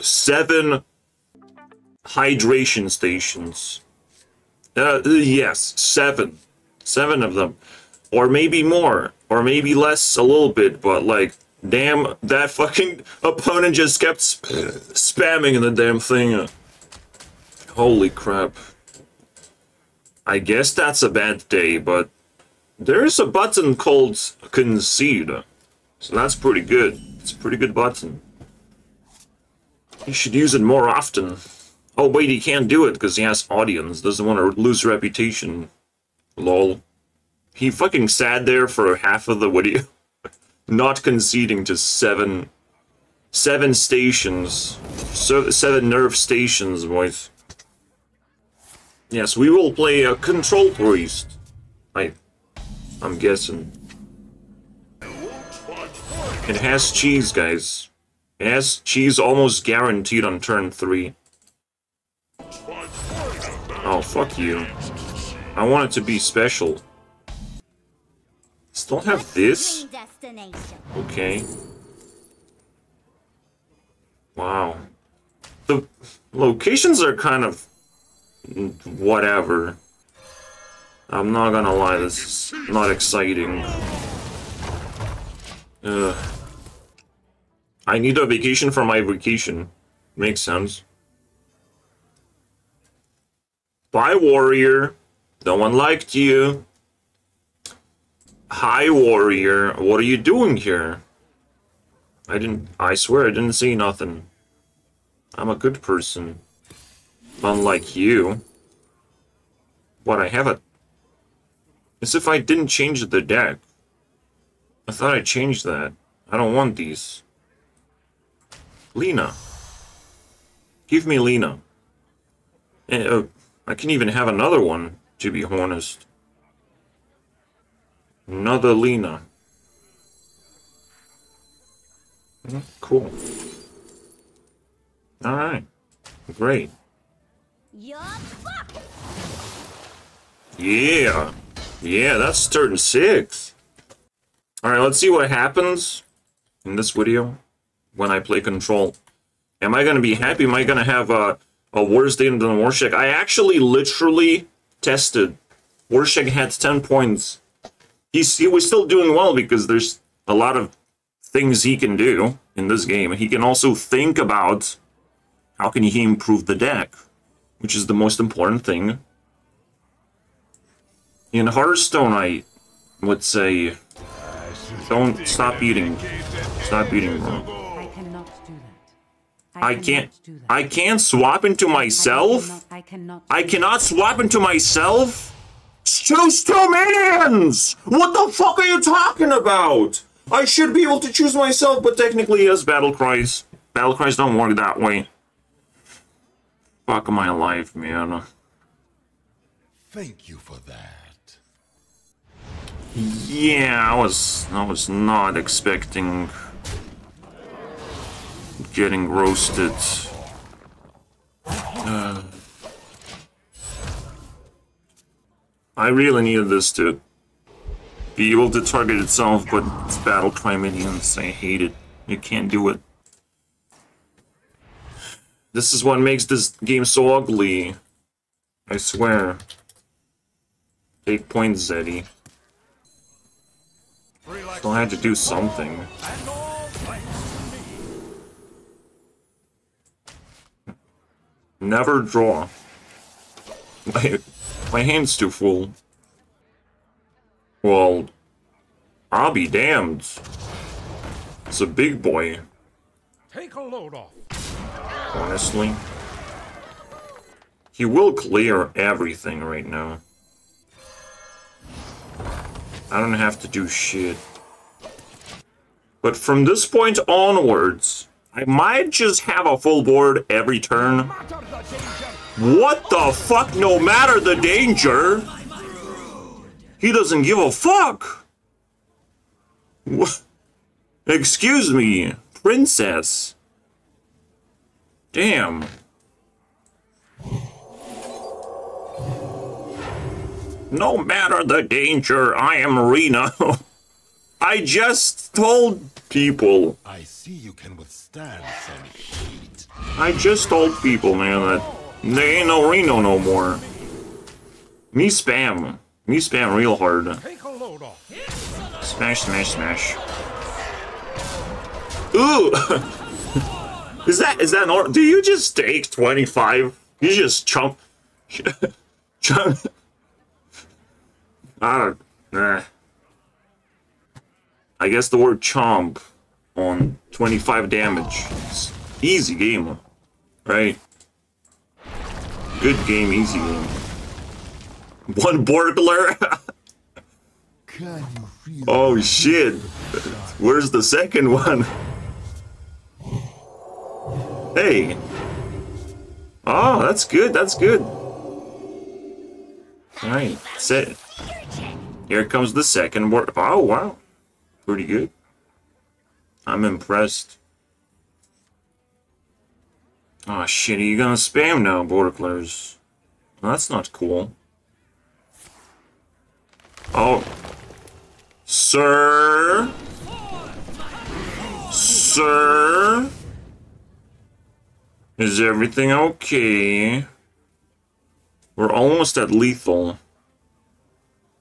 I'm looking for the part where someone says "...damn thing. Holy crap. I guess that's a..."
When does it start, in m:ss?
0:15.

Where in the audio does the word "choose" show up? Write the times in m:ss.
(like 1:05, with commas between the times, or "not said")
3:05, 3:11.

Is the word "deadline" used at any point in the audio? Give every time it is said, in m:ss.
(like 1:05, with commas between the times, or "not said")
not said.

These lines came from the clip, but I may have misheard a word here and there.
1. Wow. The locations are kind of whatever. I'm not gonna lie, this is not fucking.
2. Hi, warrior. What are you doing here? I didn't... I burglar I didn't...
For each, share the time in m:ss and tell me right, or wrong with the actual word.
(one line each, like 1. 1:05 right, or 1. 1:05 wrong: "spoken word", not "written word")
1. 1:14 wrong: "exciting", not "fucking"
2. 1:38 wrong: "swear", not "burglar".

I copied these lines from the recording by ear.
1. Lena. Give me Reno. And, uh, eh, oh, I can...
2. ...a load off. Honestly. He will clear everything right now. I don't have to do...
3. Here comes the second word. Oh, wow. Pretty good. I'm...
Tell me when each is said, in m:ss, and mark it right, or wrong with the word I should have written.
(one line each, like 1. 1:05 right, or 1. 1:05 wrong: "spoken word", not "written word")
1. 1:58 wrong: "Lena", not "Reno"
2. 4:13 right
3. 5:52 right.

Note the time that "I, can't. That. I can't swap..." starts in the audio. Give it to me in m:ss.
2:59.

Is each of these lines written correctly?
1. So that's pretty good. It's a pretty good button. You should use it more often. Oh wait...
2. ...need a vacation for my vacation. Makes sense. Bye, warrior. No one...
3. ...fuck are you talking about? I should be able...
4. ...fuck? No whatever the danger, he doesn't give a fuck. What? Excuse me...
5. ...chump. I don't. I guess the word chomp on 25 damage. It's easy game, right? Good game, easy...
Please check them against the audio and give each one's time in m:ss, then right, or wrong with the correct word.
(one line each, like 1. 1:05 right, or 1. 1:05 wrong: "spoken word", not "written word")
1. 0:25 right
2. 1:27 right
3. 3:08 right
4. 4:33 wrong: "matter", not "whatever"
5. 5:19 right.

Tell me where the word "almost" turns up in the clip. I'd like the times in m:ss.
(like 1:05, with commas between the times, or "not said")
0:59, 6:18.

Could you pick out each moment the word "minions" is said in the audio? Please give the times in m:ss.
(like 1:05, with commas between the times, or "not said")
3:06.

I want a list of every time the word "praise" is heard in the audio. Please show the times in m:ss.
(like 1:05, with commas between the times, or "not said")
not said.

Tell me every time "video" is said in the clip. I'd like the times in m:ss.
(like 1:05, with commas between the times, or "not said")
0:39, 2:26.